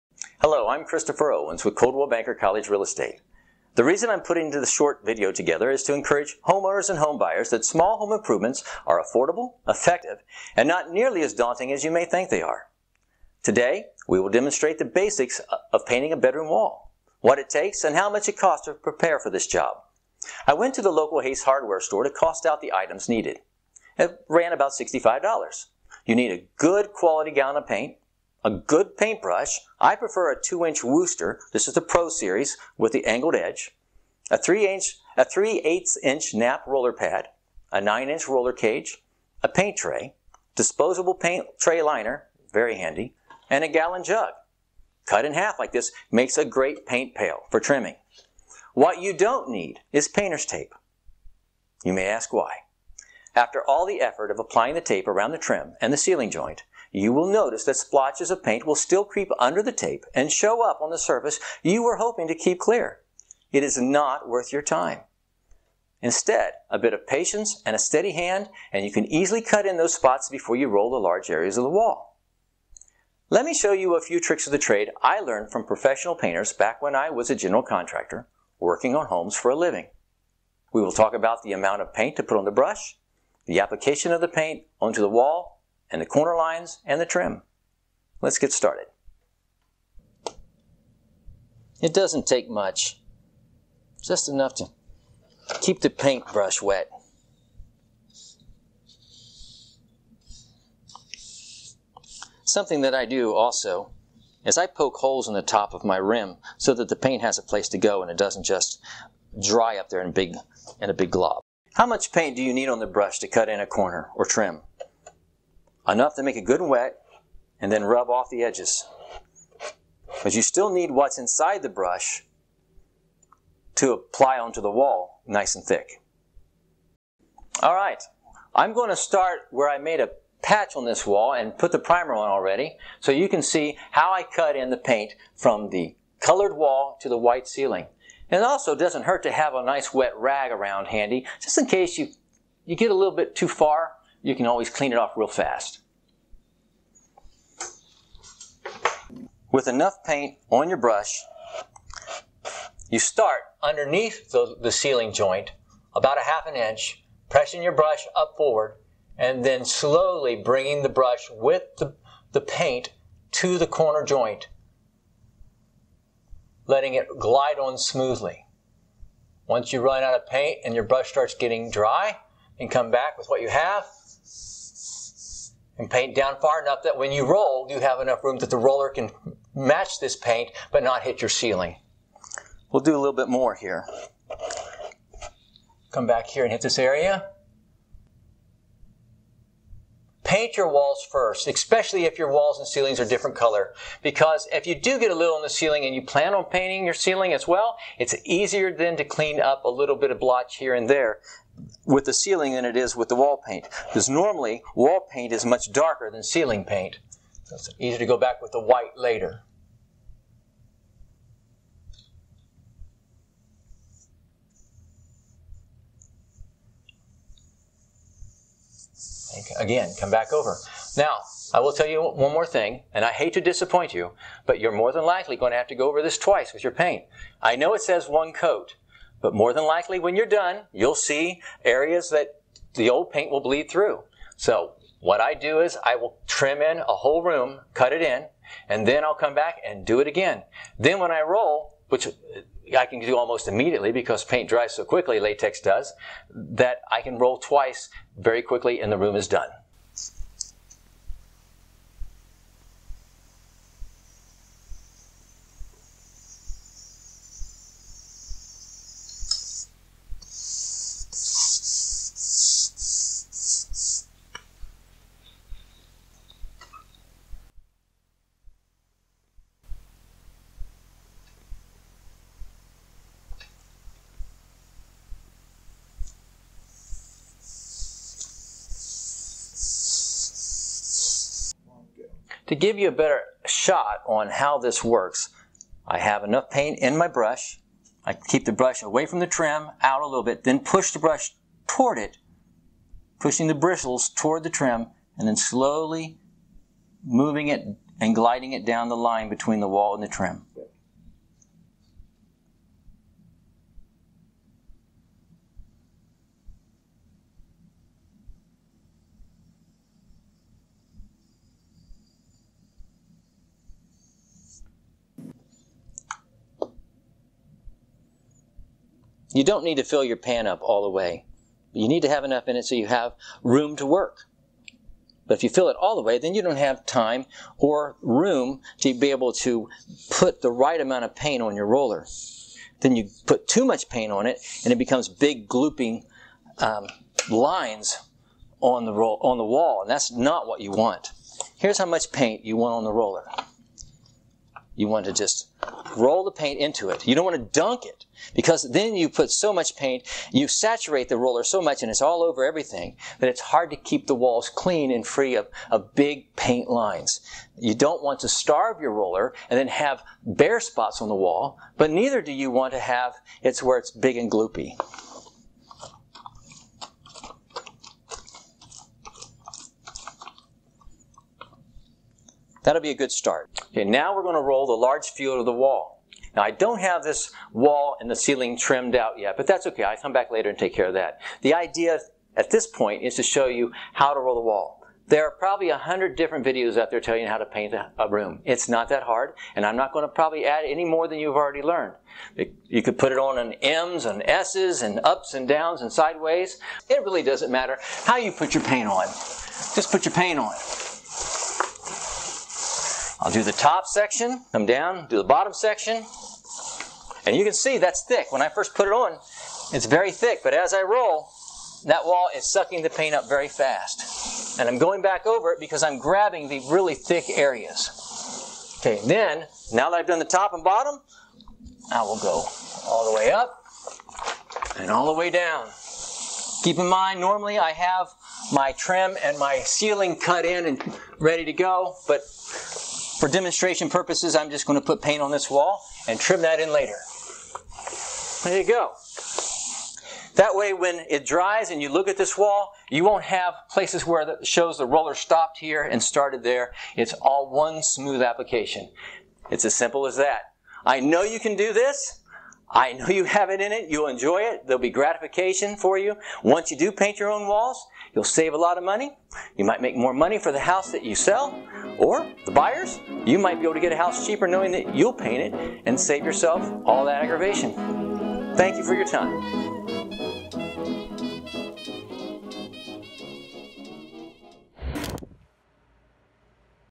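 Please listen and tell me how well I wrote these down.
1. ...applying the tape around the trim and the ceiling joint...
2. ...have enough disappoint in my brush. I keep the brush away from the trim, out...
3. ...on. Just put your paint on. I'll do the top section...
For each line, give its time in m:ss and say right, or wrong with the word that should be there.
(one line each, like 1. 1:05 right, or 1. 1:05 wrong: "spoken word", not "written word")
1. 0:54 right
2. 4:45 wrong: "paint", not "disappoint"
3. 6:38 right.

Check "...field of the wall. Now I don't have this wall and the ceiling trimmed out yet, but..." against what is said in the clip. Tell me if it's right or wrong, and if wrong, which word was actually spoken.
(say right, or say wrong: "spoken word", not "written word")
right.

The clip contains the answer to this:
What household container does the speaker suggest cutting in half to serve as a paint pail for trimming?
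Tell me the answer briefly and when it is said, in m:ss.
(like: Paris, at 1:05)
gallon jug, at 0:43.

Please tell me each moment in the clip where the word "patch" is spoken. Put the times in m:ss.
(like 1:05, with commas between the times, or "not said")
2:10.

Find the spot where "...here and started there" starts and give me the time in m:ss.
7:25.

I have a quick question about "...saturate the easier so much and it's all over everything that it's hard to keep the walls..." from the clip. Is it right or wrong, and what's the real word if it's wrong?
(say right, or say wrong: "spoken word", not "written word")
wrong: "roller", not "easier".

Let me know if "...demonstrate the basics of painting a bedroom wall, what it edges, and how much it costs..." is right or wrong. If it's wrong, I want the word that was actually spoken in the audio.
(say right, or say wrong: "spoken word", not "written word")
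wrong: "takes", not "edges".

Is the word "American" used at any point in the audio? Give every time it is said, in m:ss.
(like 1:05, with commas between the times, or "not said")
not said.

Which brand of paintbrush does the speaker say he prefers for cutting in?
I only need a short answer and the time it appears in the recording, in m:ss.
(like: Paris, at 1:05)
Wooster, at 0:30.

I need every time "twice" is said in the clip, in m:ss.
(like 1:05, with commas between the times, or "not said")
3:46, 4:07.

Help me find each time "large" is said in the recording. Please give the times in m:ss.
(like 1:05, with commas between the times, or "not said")
1:10, 6:14.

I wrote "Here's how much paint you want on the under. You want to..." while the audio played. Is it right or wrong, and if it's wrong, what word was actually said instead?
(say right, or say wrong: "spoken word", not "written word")
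wrong: "roller", not "under".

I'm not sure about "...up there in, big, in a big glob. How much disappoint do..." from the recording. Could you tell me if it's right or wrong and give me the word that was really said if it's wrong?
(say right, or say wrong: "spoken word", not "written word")
wrong: "paint", not "disappoint".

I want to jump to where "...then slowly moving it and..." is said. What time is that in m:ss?
4:55.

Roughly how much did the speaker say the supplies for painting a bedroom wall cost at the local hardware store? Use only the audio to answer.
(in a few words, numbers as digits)
$65.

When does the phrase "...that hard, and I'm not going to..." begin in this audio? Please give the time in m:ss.
6:28.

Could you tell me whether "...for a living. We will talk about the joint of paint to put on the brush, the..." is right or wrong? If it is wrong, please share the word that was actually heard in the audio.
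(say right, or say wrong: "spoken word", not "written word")
wrong: "amount", not "joint".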